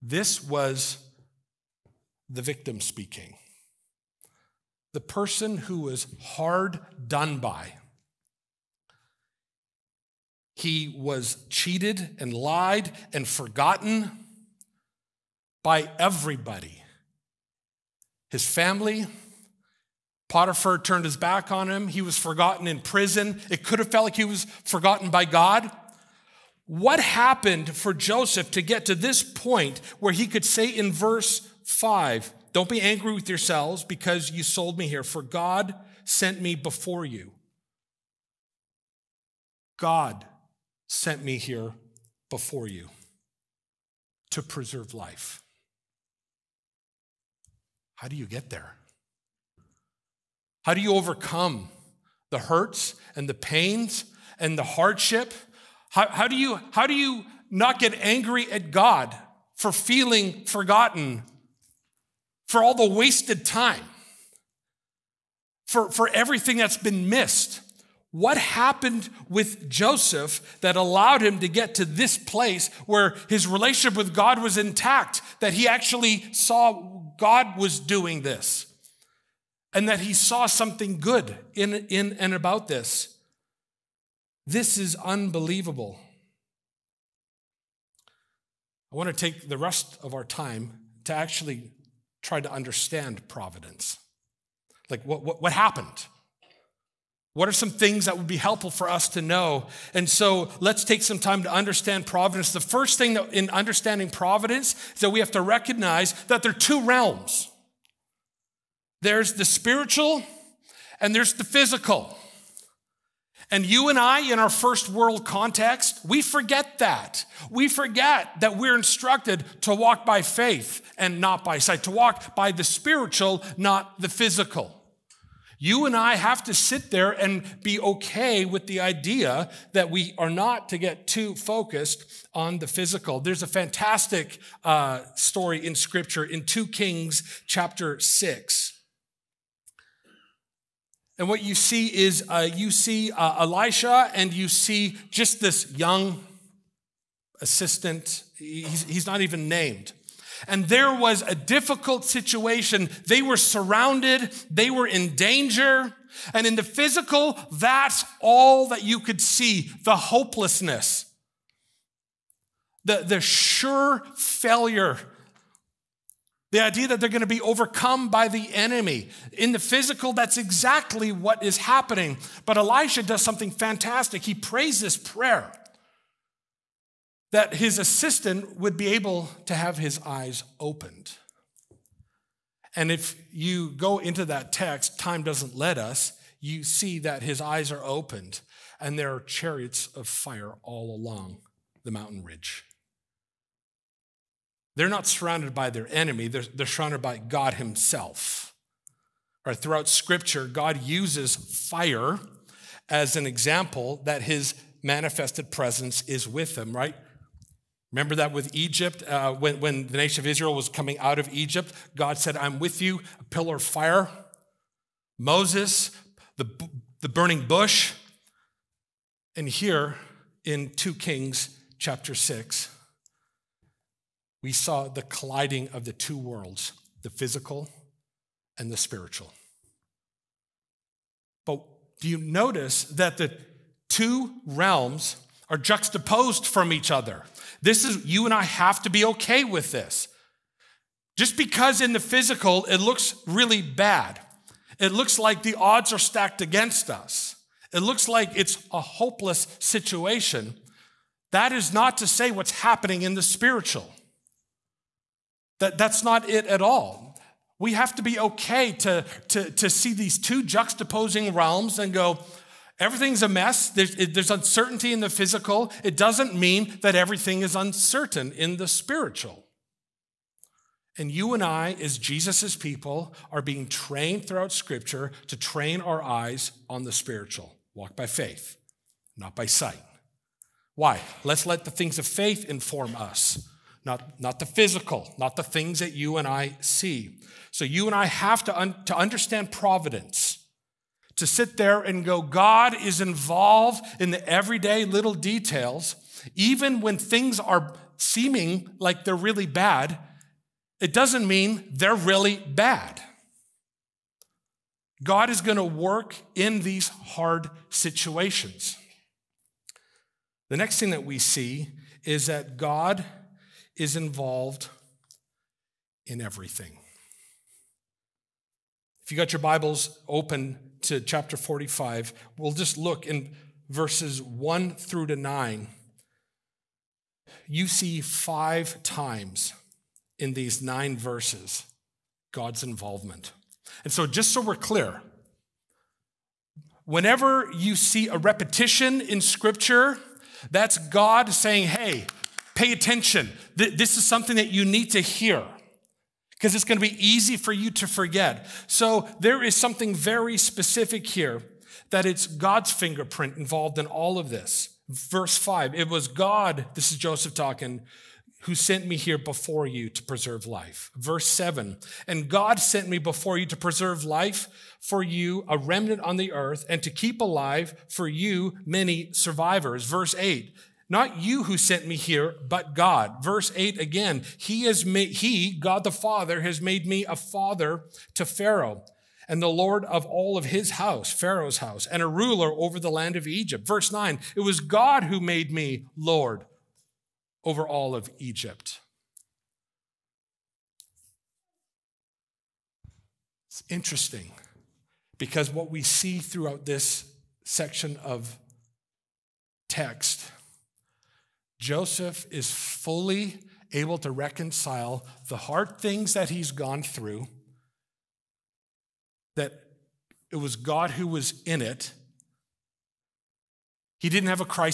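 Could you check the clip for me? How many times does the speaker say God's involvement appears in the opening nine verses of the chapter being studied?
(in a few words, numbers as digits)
5.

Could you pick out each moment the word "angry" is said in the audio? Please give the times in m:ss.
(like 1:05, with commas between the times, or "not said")
0:32, 0:58.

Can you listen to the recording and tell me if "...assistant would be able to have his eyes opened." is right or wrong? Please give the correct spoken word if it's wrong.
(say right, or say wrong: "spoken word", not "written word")
right.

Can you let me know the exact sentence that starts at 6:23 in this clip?
Verse 9, it was God who made me Lord over all of Egypt.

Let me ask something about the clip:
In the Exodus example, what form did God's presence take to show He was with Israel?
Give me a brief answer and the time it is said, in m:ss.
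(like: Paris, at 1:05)
A pillar of fire, at 3:33.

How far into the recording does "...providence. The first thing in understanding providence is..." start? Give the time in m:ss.
1:42.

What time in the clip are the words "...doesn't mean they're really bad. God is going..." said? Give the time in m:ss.
5:00.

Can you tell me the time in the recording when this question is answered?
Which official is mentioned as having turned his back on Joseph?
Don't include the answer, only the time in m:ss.
0:20.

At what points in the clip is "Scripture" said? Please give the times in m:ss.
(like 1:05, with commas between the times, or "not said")
2:15, 3:19, 4:34, 5:39.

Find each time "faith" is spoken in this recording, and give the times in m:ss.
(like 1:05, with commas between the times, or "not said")
2:00, 4:38, 4:42.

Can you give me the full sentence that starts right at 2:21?
And what you see is uh, you see uh, Elisha and you see just this young assistant.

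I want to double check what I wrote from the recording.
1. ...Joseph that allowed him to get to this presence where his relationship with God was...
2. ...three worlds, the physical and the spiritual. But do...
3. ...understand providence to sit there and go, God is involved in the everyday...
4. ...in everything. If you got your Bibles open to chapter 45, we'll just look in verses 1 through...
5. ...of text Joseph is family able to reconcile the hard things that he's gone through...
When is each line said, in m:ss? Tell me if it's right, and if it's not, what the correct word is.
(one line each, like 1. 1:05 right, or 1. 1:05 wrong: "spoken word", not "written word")
1. 1:09 wrong: "place", not "presence"
2. 3:45 wrong: "two", not "three"
3. 4:48 right
4. 5:16 right
5. 6:38 wrong: "fully", not "family".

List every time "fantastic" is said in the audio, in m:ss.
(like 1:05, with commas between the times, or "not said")
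2:13, 2:53.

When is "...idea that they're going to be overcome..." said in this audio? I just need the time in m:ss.
2:46.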